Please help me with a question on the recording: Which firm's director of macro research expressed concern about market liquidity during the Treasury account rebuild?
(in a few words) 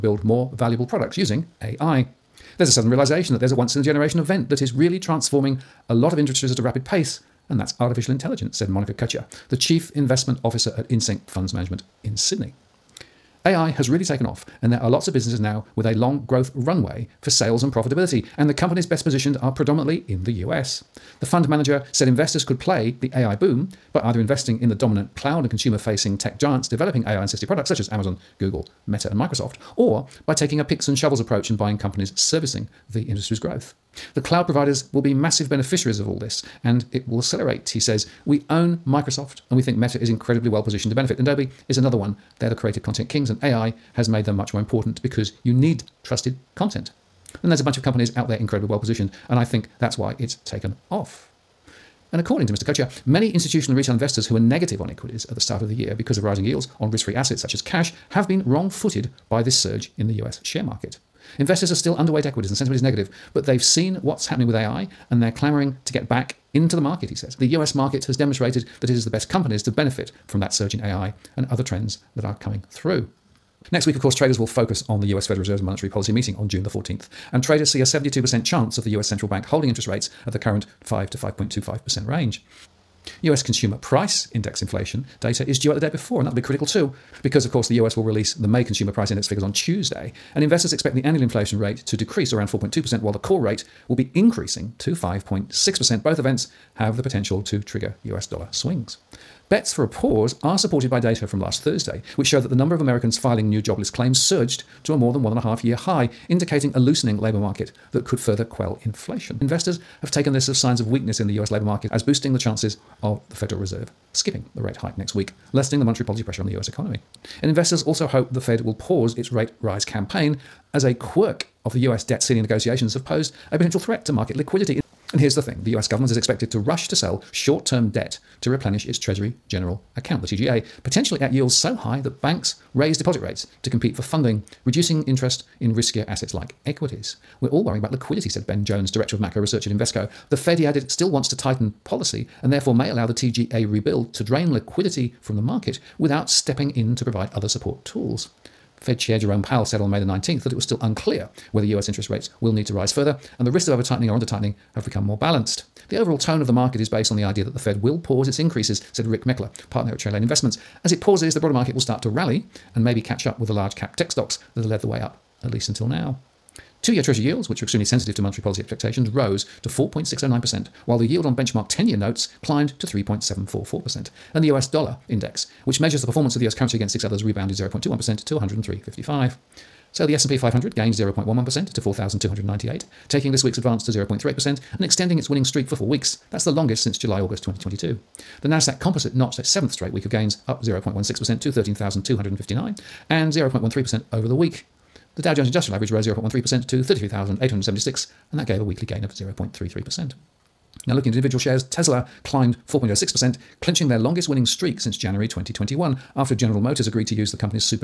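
Invesco.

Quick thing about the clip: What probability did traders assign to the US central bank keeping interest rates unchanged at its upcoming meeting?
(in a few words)
72%.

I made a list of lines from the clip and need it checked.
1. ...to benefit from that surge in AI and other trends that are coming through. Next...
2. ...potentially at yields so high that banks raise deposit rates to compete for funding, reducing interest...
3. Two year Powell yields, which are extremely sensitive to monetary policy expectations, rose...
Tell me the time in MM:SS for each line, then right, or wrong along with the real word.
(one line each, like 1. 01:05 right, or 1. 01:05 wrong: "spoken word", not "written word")
1. 01:09 right
2. 02:10 right
3. 02:46 wrong: "Treasury", not "Powell".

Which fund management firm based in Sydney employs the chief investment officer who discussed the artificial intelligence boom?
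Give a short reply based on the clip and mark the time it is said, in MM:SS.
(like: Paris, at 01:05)
InSync Funds Management, at 00:10.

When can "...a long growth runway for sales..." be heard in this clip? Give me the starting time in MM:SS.
00:15.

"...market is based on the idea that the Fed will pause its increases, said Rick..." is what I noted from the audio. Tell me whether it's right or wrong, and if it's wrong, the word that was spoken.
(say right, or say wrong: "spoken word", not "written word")
right.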